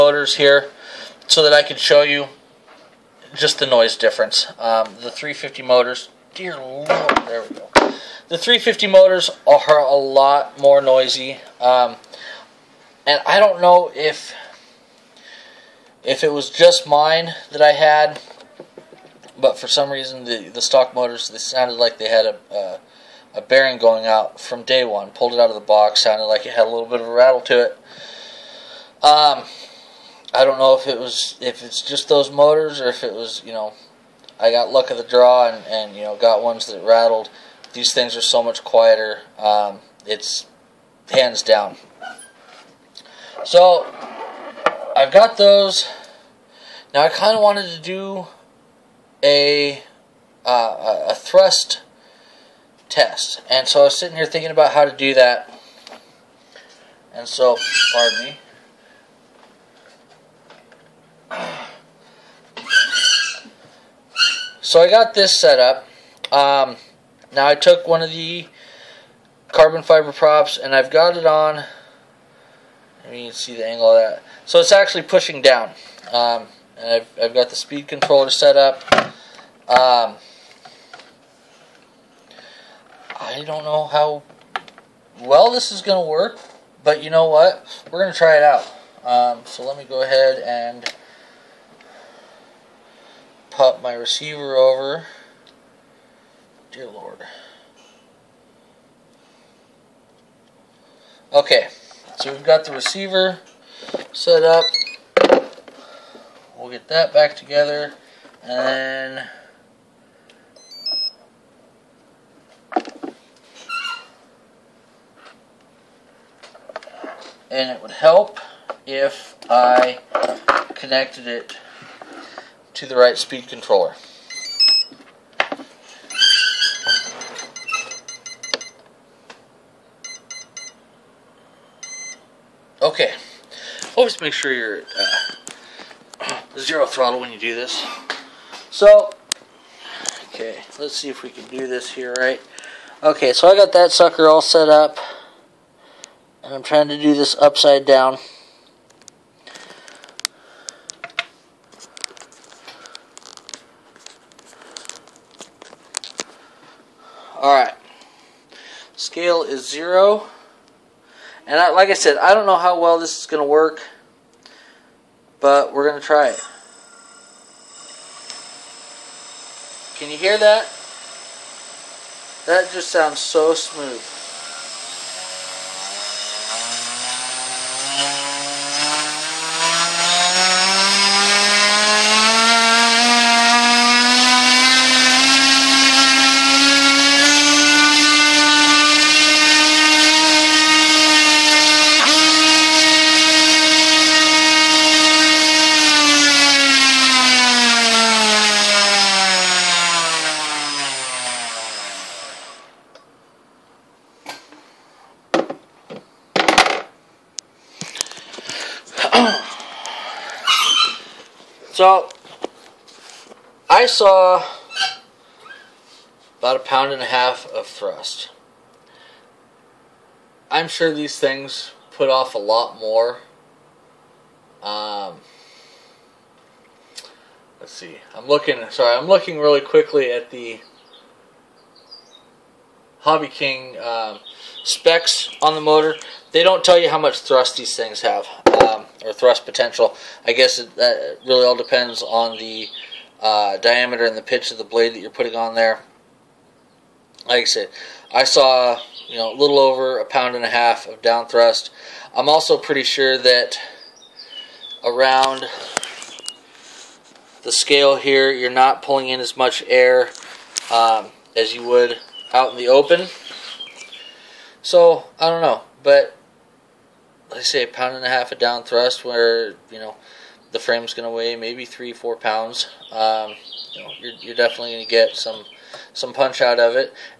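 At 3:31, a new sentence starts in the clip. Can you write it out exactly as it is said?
So I saw about a pound and a half of thrust.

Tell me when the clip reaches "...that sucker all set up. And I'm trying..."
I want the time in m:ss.
2:23.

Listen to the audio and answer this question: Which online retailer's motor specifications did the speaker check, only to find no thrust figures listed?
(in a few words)
Hobby King.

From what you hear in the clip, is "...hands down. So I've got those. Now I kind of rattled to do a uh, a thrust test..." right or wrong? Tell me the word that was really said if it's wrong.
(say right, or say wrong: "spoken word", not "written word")
wrong: "wanted", not "rattled".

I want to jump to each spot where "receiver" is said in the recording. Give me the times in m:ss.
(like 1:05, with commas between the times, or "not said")
1:33, 1:42.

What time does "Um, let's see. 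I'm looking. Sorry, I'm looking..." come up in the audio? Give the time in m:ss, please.
3:44.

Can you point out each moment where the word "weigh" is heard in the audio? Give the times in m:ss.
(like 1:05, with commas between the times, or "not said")
4:31.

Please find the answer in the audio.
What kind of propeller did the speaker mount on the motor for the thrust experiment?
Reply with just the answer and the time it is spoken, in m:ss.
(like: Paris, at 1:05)
carbon fiber, at 1:09.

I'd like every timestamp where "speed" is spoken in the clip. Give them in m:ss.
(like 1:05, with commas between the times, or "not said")
1:17, 2:03.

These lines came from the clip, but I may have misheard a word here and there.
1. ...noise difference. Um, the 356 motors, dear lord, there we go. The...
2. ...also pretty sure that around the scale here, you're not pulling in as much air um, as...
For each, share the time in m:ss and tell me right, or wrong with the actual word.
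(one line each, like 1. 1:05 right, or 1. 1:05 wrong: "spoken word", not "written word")
1. 0:03 wrong: "350", not "356"
2. 4:12 right.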